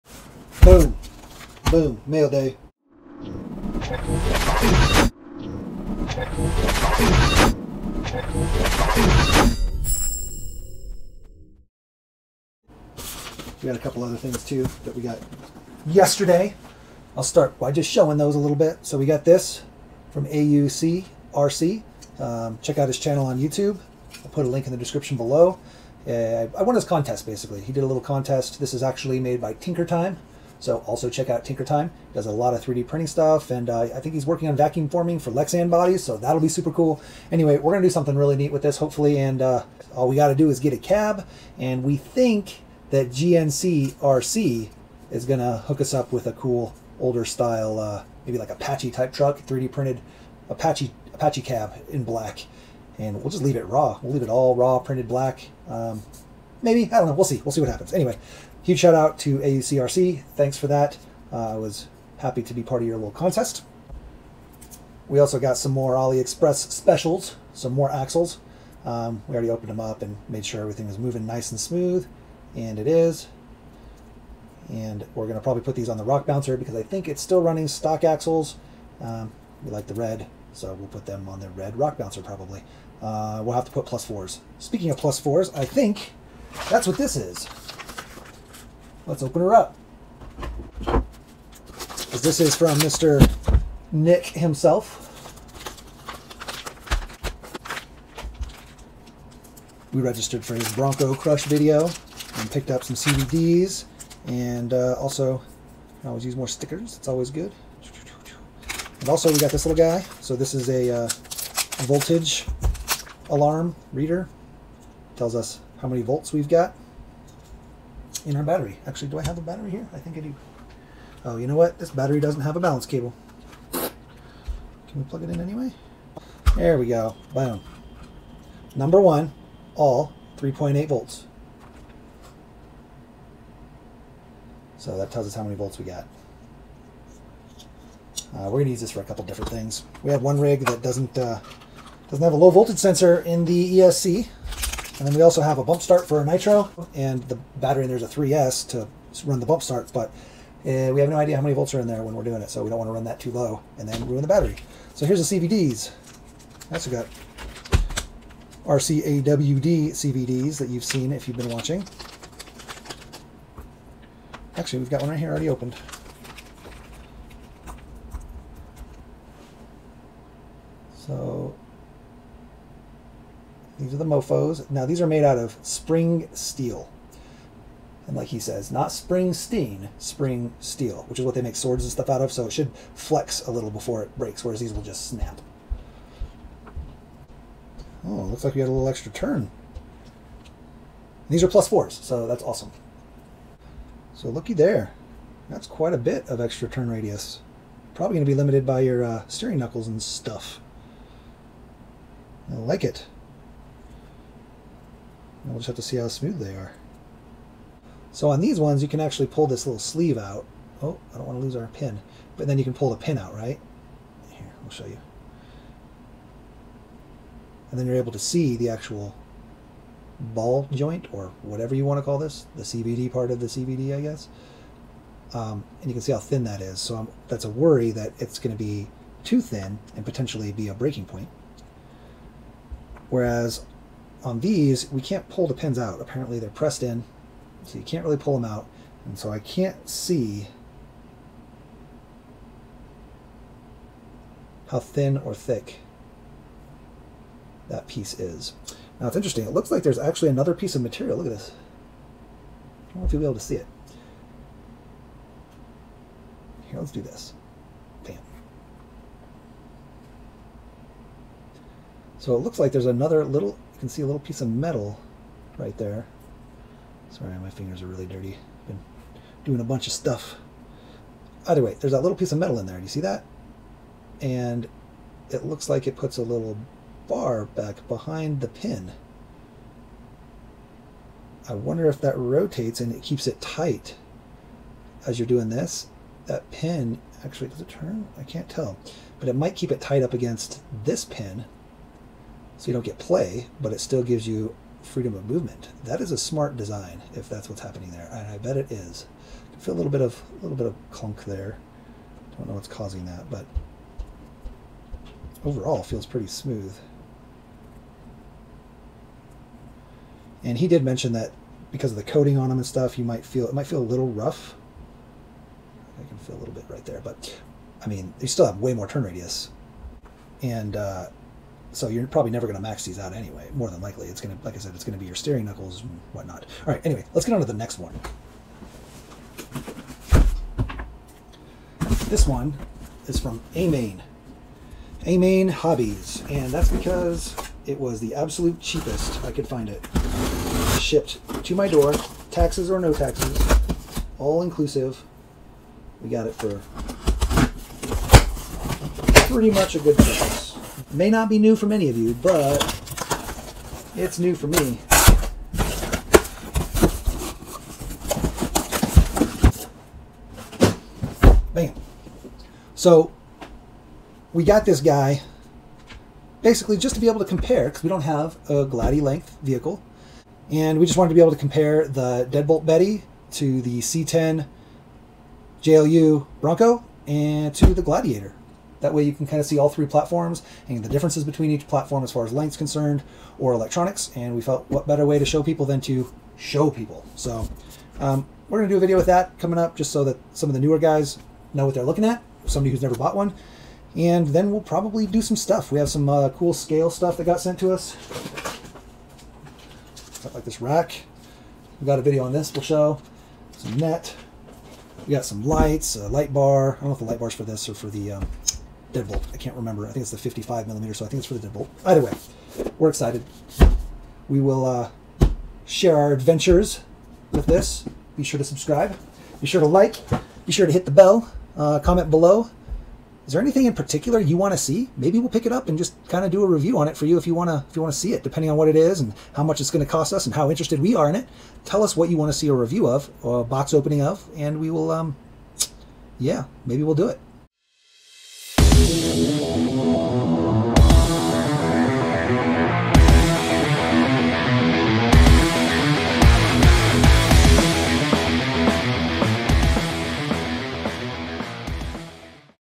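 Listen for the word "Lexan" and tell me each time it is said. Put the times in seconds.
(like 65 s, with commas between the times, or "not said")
35 s.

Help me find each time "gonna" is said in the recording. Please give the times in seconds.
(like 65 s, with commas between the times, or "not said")
37 s, 45 s.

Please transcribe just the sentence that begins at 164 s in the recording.
Actually, we've got one right here already opened.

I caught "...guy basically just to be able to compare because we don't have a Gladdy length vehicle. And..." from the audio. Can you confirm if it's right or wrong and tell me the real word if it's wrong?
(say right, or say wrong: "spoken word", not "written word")
right.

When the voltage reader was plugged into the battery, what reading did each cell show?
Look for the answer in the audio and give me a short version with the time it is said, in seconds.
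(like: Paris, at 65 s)
3.8 volts, at 130 s.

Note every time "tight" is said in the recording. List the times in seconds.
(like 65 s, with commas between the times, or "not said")
283 s, 289 s.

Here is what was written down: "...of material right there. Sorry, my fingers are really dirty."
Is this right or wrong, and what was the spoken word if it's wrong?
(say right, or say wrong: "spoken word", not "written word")
wrong: "metal", not "material".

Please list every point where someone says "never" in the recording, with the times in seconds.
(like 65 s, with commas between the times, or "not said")
322 s, 392 s.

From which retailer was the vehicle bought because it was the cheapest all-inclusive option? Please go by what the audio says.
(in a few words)
Amain Hobbies.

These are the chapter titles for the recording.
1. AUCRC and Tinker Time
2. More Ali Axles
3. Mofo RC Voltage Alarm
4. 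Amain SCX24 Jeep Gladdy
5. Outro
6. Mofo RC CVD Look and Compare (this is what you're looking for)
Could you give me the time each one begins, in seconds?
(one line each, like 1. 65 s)
1. 19 s
2. 64 s
3. 93 s
4. 328 s
5. 417 s
6. 153 s.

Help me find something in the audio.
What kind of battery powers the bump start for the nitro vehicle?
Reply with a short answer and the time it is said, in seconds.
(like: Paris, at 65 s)
3S, at 148 s.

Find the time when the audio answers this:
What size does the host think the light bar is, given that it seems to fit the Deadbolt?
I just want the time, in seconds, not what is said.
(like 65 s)
410 s.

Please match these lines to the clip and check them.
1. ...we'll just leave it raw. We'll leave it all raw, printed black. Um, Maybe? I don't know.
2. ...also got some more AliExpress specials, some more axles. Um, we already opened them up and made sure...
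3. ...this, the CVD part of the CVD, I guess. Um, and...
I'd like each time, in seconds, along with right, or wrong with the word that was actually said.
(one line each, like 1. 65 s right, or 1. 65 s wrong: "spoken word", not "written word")
1. 53 s right
2. 65 s right
3. 222 s right.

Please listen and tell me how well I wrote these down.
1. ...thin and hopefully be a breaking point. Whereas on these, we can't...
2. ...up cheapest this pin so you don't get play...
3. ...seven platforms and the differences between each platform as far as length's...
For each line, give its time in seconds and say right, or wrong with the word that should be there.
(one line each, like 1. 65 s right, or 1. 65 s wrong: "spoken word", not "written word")
1. 229 s wrong: "potentially", not "hopefully"
2. 290 s wrong: "against", not "cheapest"
3. 379 s wrong: "three", not "seven".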